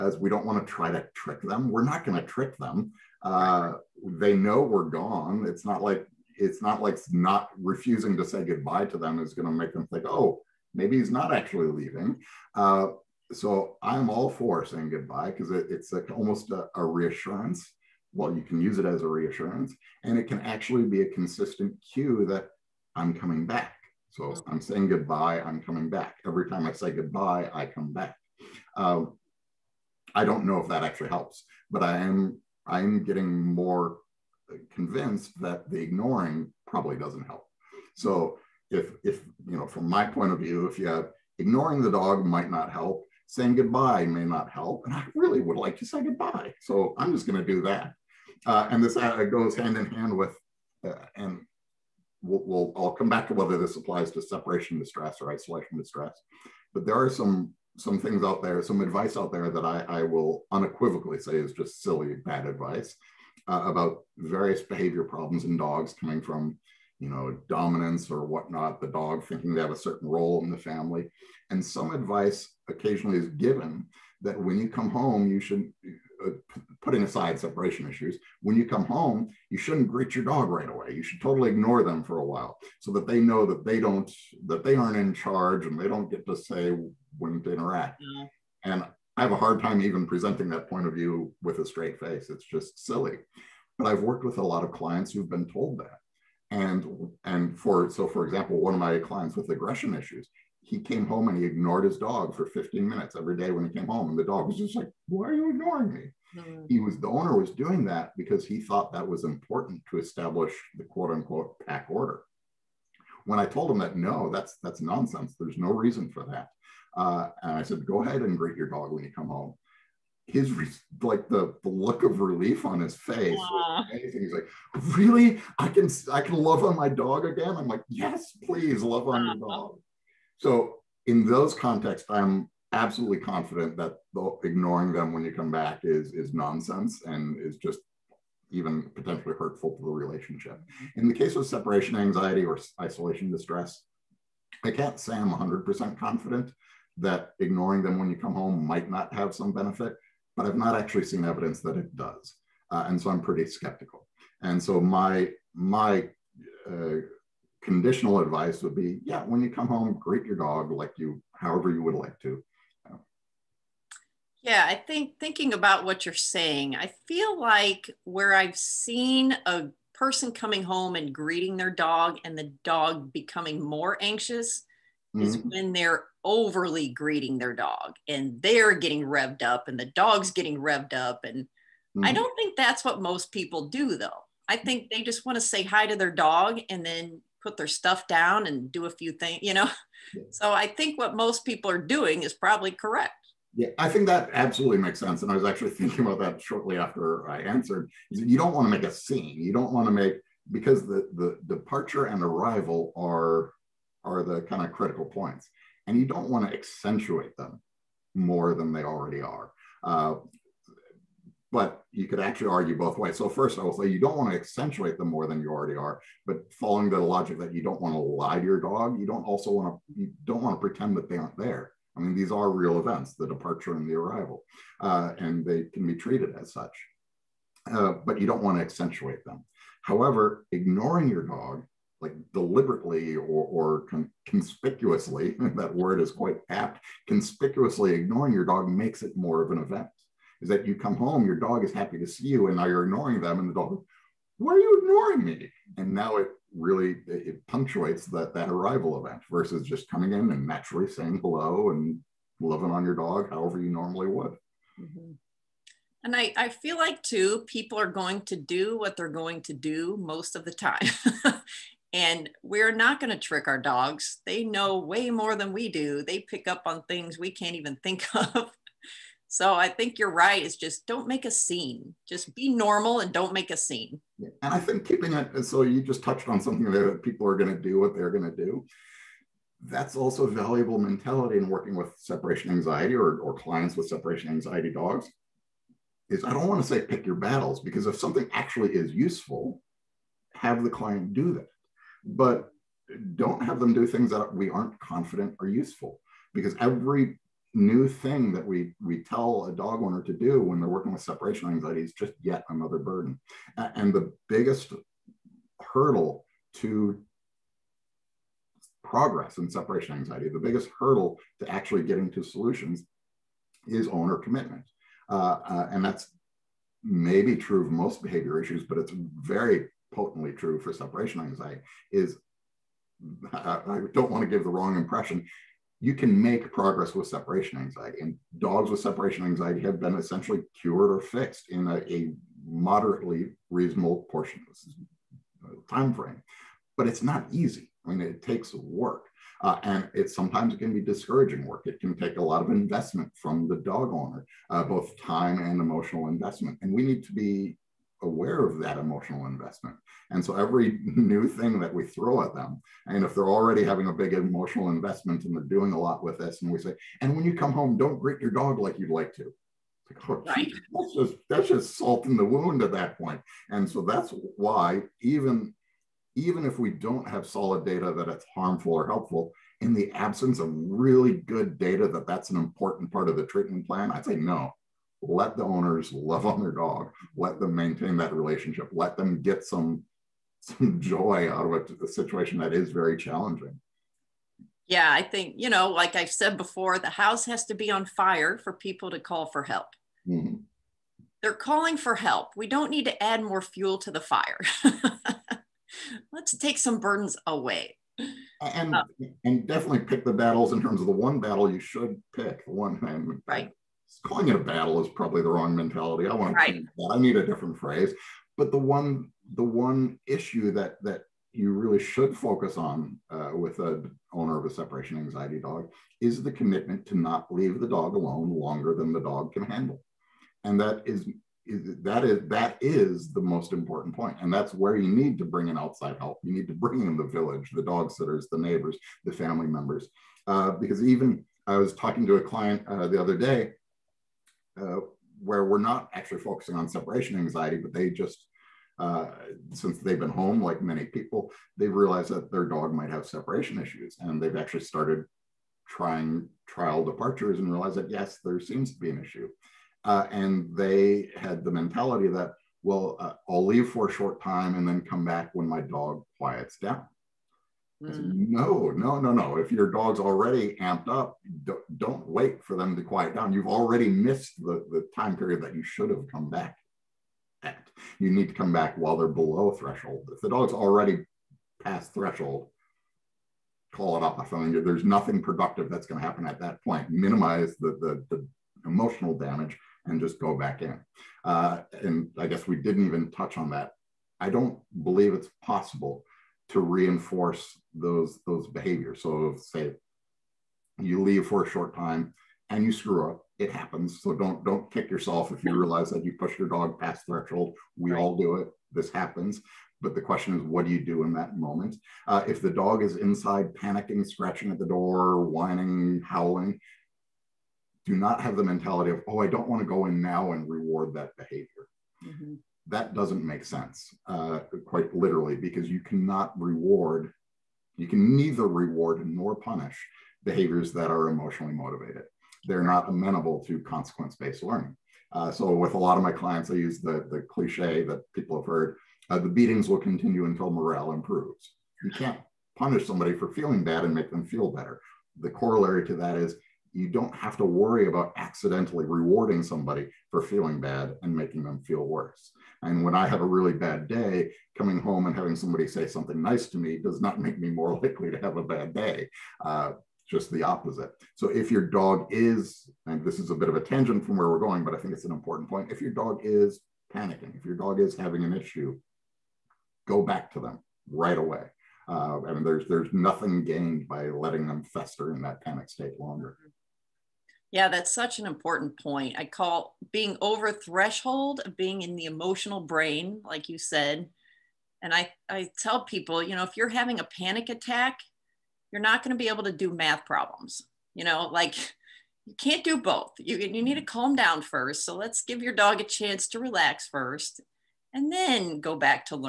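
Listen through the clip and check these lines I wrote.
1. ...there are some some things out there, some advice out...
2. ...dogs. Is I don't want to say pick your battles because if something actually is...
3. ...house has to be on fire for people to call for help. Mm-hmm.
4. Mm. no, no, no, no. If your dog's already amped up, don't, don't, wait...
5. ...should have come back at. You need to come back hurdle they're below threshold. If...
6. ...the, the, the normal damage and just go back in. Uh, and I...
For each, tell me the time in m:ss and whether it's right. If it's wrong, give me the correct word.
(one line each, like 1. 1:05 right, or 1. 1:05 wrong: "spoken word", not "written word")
1. 0:56 right
2. 4:44 right
3. 6:26 right
4. 7:37 right
5. 7:45 wrong: "while", not "hurdle"
6. 7:57 wrong: "emotional", not "normal".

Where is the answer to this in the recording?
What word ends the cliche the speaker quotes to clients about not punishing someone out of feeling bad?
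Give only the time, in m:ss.
8:50.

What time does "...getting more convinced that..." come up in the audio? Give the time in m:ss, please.
0:33.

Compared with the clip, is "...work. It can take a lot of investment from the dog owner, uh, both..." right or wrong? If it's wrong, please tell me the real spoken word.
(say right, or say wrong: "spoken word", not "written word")
right.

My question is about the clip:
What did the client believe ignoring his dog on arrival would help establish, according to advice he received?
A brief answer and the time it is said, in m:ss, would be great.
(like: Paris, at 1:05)
pack order, at 1:51.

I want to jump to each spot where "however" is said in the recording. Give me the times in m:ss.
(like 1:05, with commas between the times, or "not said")
2:41, 3:49, 4:13.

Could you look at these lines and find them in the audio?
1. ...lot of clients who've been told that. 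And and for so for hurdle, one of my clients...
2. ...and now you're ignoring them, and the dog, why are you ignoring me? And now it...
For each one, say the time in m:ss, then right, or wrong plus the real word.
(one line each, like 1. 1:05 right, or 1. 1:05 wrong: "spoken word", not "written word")
1. 1:34 wrong: "example", not "hurdle"
2. 4:02 right.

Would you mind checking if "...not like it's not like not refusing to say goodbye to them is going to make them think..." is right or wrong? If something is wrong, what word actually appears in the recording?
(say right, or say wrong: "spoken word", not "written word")
right.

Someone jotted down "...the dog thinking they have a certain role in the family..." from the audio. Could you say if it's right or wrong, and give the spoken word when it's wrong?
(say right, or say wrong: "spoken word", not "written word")
right.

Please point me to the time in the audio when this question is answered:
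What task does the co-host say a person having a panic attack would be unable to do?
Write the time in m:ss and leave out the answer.
9:39.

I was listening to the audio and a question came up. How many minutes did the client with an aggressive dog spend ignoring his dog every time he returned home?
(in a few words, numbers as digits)
15.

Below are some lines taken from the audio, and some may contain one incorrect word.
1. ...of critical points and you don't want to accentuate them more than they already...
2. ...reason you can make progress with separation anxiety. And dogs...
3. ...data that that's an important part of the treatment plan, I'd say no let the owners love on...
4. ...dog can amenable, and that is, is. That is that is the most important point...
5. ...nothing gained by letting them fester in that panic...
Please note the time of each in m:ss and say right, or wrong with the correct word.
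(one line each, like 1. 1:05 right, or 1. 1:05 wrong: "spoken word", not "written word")
1. 3:24 right
2. 5:24 wrong: "impression", not "reason"
3. 6:11 right
4. 6:59 wrong: "handle", not "amenable"
5. 9:22 right.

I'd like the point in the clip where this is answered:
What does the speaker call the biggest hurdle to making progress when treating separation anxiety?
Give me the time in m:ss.
5:13.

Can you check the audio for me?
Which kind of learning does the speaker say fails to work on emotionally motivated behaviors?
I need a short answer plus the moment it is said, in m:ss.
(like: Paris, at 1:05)
consequence based learning, at 8:43.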